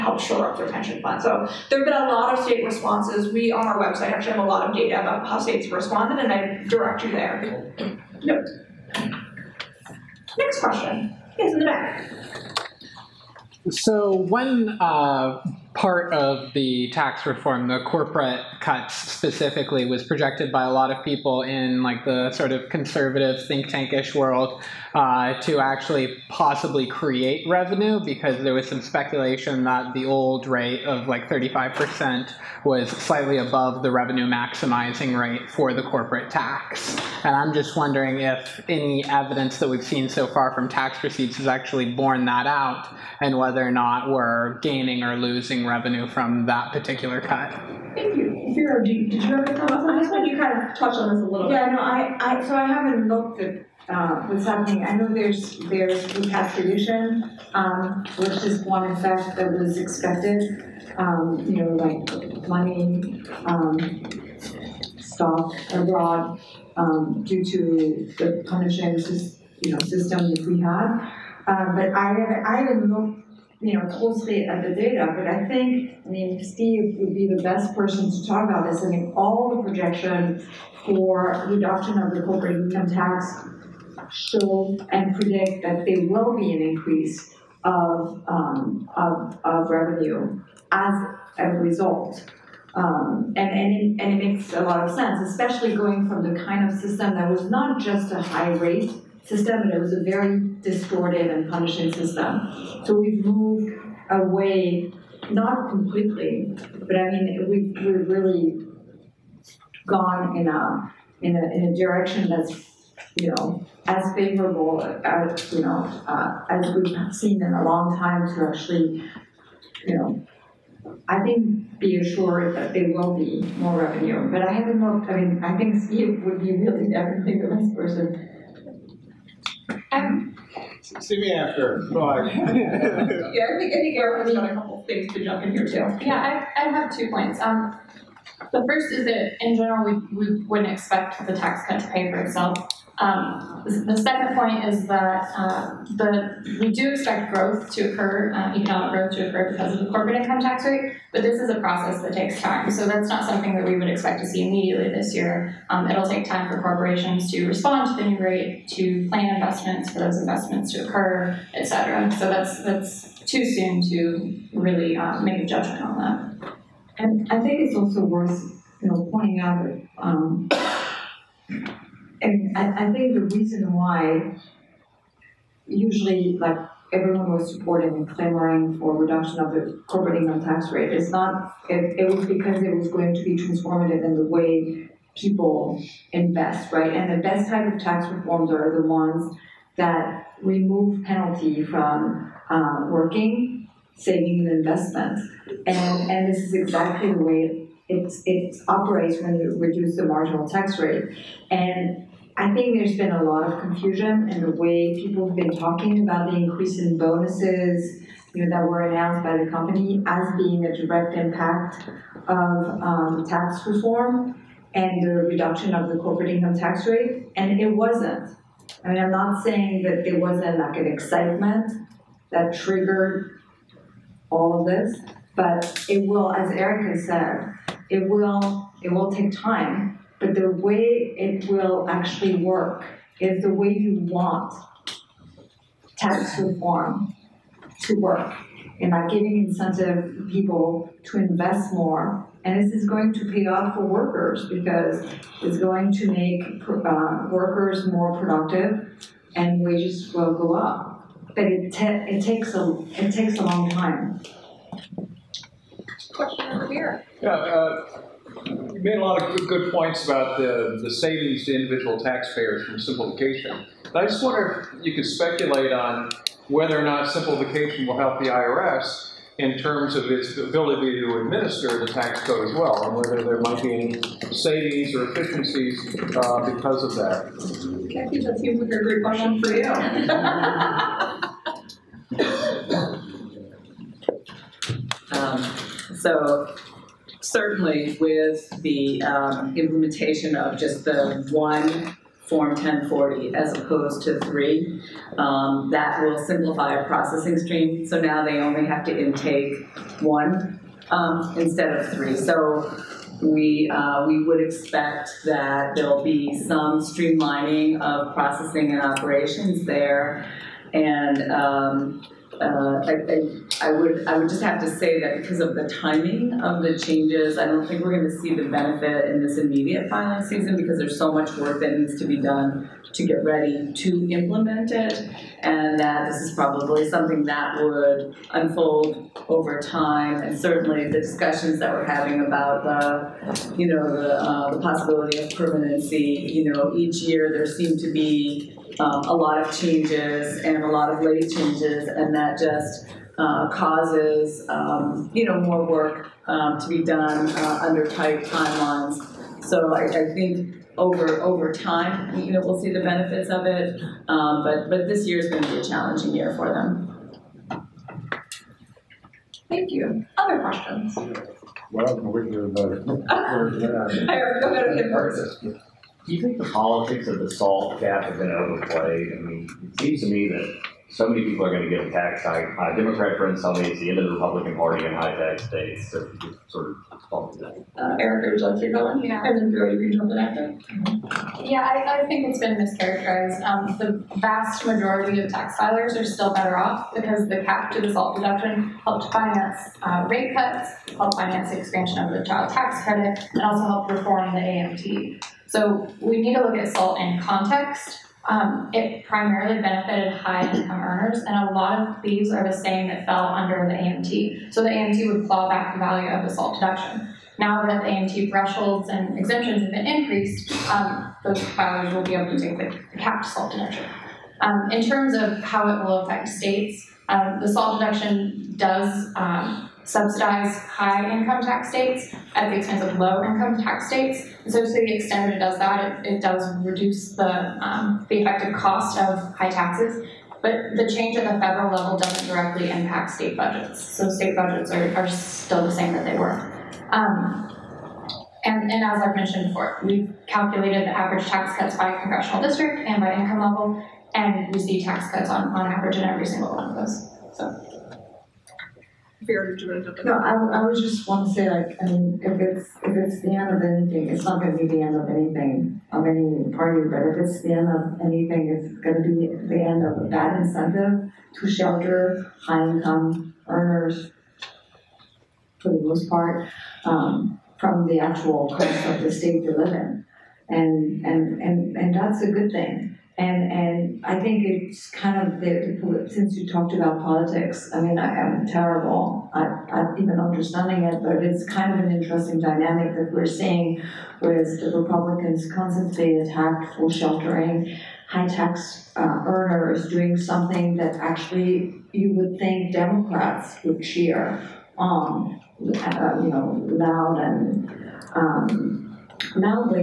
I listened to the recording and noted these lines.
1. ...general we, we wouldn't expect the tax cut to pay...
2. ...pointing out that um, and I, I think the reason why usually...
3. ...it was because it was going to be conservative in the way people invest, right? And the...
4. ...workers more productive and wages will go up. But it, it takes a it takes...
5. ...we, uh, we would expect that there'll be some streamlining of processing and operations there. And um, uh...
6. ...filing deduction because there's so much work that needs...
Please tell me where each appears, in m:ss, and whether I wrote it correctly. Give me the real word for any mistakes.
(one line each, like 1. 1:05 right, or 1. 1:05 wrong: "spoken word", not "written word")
1. 2:19 right
2. 2:49 right
3. 3:01 wrong: "transformative", not "conservative"
4. 4:07 right
5. 5:03 right
6. 5:19 wrong: "season", not "deduction".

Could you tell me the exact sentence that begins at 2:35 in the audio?
Um, it'll take time for corporations to respond to the new rate, to plan investments, for those investments to occur, et cetera.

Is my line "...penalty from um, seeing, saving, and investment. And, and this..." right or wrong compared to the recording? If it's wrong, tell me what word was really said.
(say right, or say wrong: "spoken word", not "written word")
wrong: "working", not "seeing".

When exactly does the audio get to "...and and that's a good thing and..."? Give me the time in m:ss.
7:51.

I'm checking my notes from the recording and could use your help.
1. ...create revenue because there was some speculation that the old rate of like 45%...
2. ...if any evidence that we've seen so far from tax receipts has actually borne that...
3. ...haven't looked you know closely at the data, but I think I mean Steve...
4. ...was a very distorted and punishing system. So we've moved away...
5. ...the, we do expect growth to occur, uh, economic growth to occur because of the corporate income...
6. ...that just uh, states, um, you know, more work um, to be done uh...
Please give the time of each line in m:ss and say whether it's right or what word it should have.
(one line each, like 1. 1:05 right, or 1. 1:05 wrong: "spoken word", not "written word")
1. 0:26 wrong: "35", not "45"
2. 0:38 right
3. 1:12 right
4. 1:39 right
5. 2:25 right
6. 5:42 wrong: "causes", not "states".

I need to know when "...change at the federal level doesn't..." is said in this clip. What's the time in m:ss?
7:10.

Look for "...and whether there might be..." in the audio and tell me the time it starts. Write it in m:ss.
4:32.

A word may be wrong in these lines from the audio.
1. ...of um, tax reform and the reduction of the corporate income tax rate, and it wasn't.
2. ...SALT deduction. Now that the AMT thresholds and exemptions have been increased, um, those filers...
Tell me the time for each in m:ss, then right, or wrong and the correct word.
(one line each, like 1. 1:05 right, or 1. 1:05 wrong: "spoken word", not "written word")
1. 3:32 right
2. 6:46 right.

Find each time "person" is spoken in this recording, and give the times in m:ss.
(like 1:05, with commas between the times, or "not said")
1:17, 2:07.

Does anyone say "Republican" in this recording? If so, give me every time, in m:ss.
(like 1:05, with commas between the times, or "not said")
6:14, 8:04.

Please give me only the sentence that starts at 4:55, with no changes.
Um, that will simplify a processing stream.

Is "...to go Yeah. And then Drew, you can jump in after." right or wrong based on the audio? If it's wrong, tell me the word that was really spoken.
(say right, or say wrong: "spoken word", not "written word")
right.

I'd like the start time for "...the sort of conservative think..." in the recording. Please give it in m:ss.
0:22.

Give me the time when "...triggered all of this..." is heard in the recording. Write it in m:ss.
3:42.